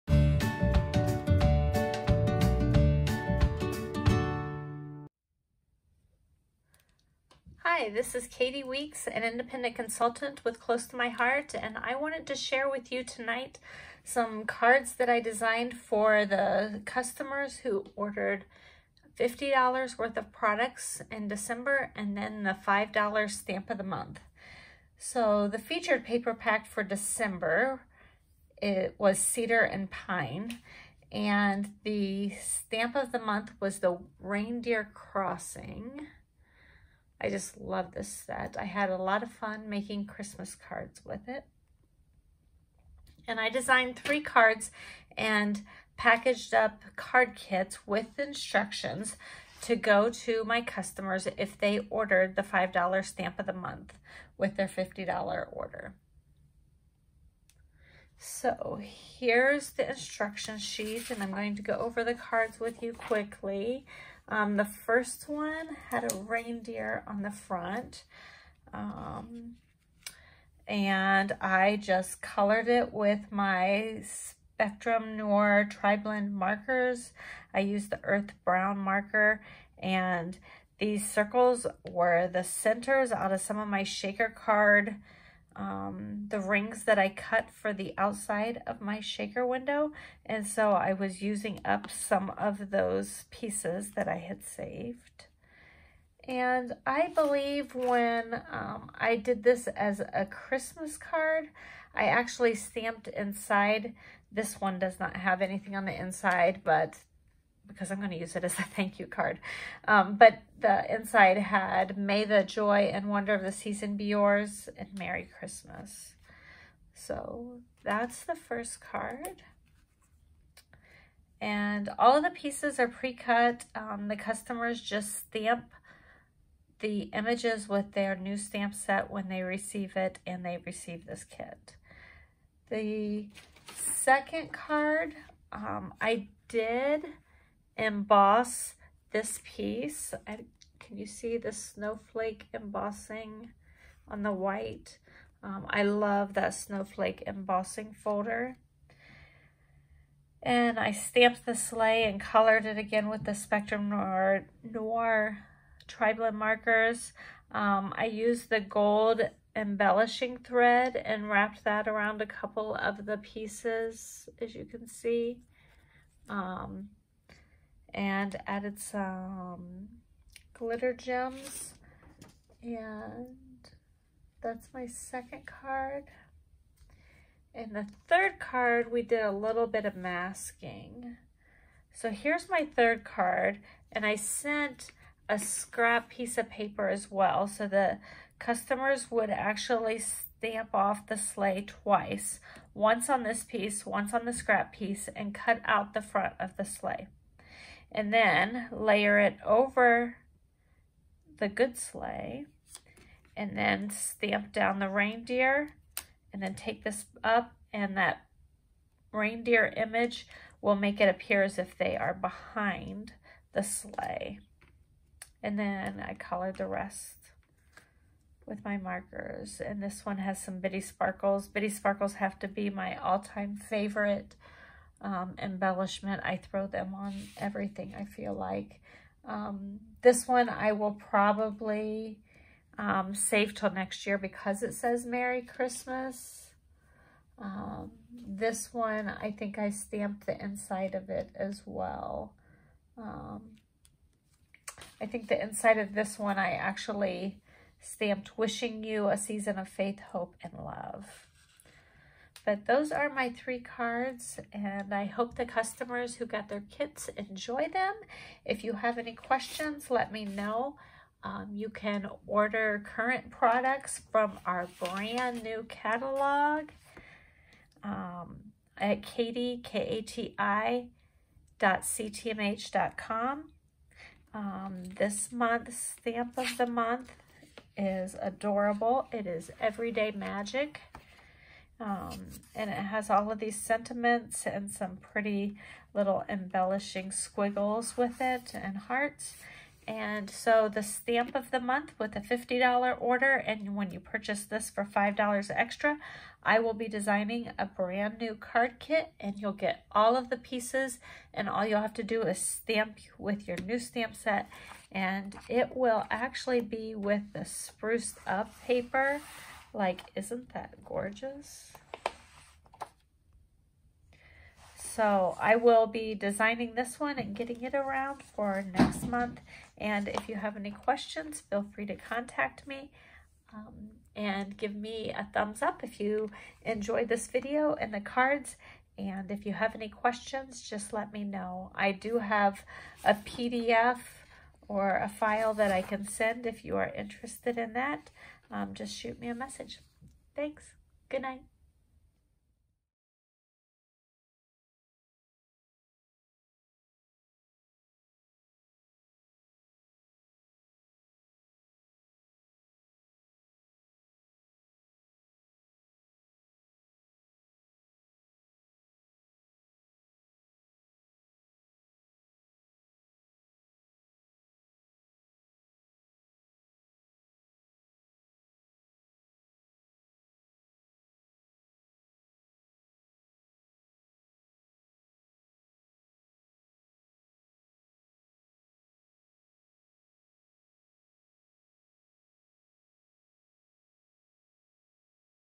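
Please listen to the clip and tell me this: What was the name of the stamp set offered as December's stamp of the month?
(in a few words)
Reindeer Crossing.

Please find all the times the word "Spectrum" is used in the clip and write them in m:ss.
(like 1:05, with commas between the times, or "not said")
1:14, 2:33.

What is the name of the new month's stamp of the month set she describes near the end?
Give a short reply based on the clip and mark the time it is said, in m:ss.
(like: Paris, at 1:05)
Everyday Magic, at 4:39.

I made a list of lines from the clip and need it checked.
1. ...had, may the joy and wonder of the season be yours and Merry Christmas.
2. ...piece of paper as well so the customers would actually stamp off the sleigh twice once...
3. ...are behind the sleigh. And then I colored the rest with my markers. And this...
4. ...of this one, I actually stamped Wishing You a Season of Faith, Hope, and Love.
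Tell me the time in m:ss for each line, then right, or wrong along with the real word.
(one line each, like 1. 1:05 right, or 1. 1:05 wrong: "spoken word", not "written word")
1. 1:51 right
2. 3:06 right
3. 3:31 right
4. 4:05 right.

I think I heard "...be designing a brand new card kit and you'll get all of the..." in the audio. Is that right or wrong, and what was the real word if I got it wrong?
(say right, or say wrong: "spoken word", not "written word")
right.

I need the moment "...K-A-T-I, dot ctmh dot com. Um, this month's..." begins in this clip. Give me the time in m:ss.
4:29.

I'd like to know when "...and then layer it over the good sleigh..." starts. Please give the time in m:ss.
3:17.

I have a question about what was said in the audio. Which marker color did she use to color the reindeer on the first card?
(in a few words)
Earth Brown.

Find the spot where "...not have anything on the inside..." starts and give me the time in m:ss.
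1:44.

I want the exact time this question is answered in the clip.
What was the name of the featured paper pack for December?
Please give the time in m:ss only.
0:29.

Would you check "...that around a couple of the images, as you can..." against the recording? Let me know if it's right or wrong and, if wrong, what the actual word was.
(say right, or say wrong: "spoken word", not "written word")
wrong: "pieces", not "images".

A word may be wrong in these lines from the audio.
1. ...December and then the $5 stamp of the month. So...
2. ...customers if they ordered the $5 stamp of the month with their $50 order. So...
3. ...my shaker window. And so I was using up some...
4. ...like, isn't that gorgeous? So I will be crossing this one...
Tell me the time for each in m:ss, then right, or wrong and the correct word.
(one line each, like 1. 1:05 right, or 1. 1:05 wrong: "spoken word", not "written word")
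1. 0:21 right
2. 0:50 right
3. 1:28 right
4. 5:09 wrong: "designing", not "crossing".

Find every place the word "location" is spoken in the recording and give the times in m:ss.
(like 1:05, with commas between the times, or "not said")
not said.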